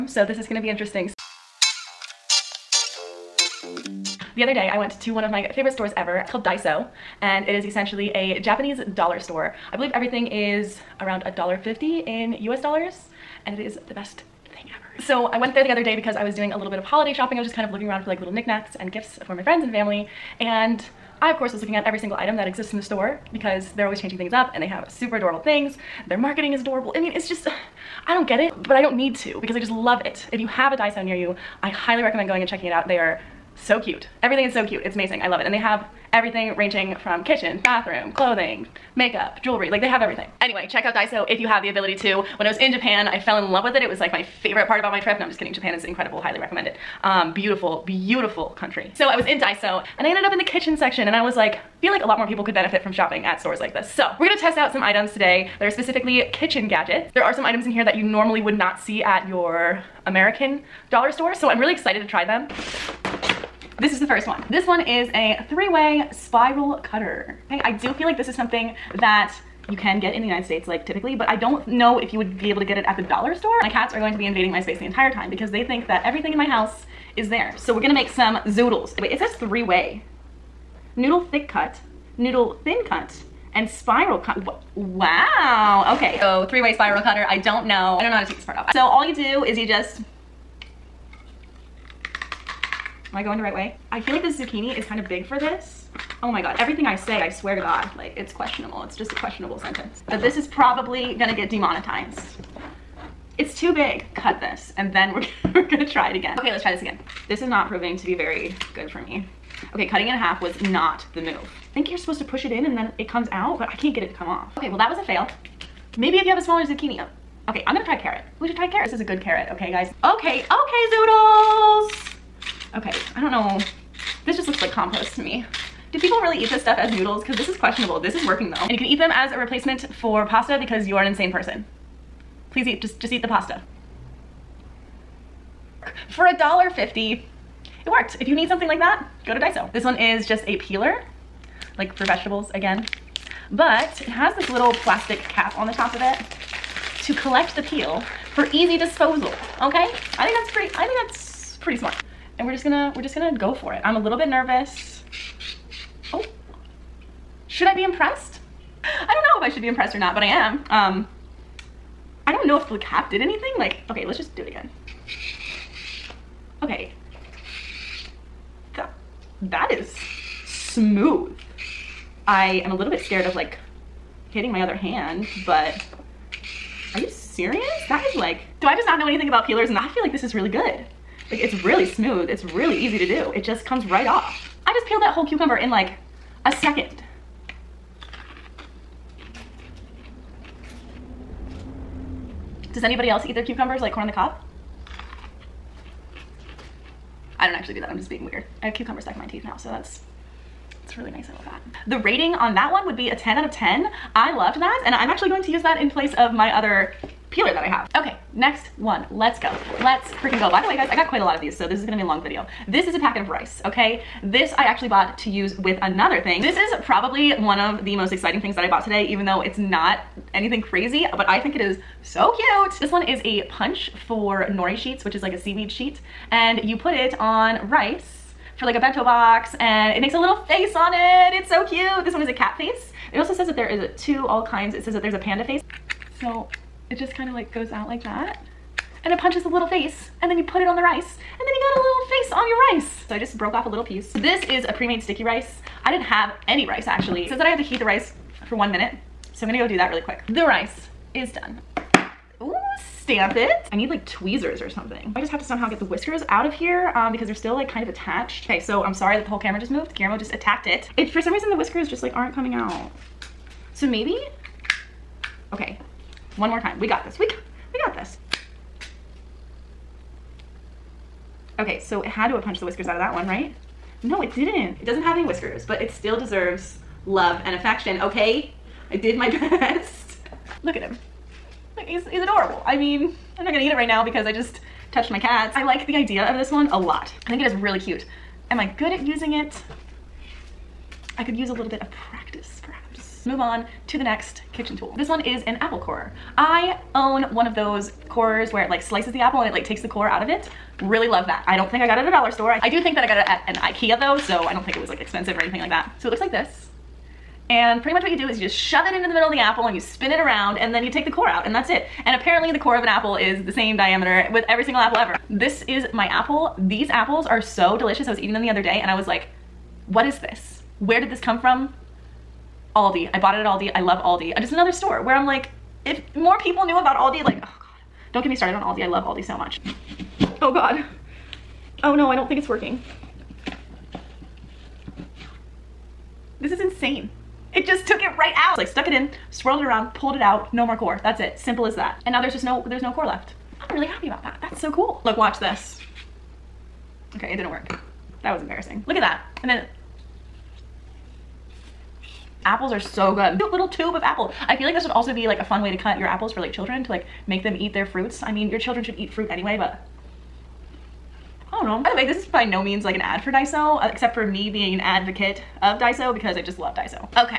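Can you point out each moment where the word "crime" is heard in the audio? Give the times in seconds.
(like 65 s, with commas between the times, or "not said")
not said.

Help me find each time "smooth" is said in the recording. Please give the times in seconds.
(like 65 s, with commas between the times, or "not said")
170 s, 181 s.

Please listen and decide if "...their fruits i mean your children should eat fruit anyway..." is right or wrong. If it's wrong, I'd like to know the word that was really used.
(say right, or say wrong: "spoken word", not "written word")
right.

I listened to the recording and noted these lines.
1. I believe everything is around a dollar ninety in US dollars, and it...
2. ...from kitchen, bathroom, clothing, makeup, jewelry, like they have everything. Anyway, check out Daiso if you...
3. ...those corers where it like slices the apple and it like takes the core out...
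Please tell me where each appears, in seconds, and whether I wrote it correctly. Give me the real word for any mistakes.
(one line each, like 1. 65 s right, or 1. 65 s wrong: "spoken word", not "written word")
1. 9 s wrong: "fifty", not "ninety"
2. 37 s right
3. 297 s right.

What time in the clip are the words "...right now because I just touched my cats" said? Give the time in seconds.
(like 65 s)
283 s.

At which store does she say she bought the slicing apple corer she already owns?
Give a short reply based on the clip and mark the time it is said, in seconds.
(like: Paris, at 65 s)
Ikea, at 303 s.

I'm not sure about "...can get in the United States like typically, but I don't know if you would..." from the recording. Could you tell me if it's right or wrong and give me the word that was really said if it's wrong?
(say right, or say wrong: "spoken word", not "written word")
right.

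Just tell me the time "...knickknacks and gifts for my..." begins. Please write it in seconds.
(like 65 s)
18 s.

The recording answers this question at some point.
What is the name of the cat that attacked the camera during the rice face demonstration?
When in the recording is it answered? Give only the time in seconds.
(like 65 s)
259 s.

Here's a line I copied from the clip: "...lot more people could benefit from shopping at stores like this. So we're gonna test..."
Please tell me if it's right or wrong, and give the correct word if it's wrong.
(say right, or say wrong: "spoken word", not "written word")
right.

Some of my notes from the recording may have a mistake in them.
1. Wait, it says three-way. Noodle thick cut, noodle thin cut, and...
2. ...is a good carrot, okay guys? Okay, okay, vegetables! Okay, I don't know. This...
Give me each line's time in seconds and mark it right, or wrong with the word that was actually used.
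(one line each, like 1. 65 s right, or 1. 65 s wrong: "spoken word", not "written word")
1. 78 s right
2. 118 s wrong: "zoodles", not "vegetables".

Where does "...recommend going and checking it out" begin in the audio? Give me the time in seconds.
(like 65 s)
32 s.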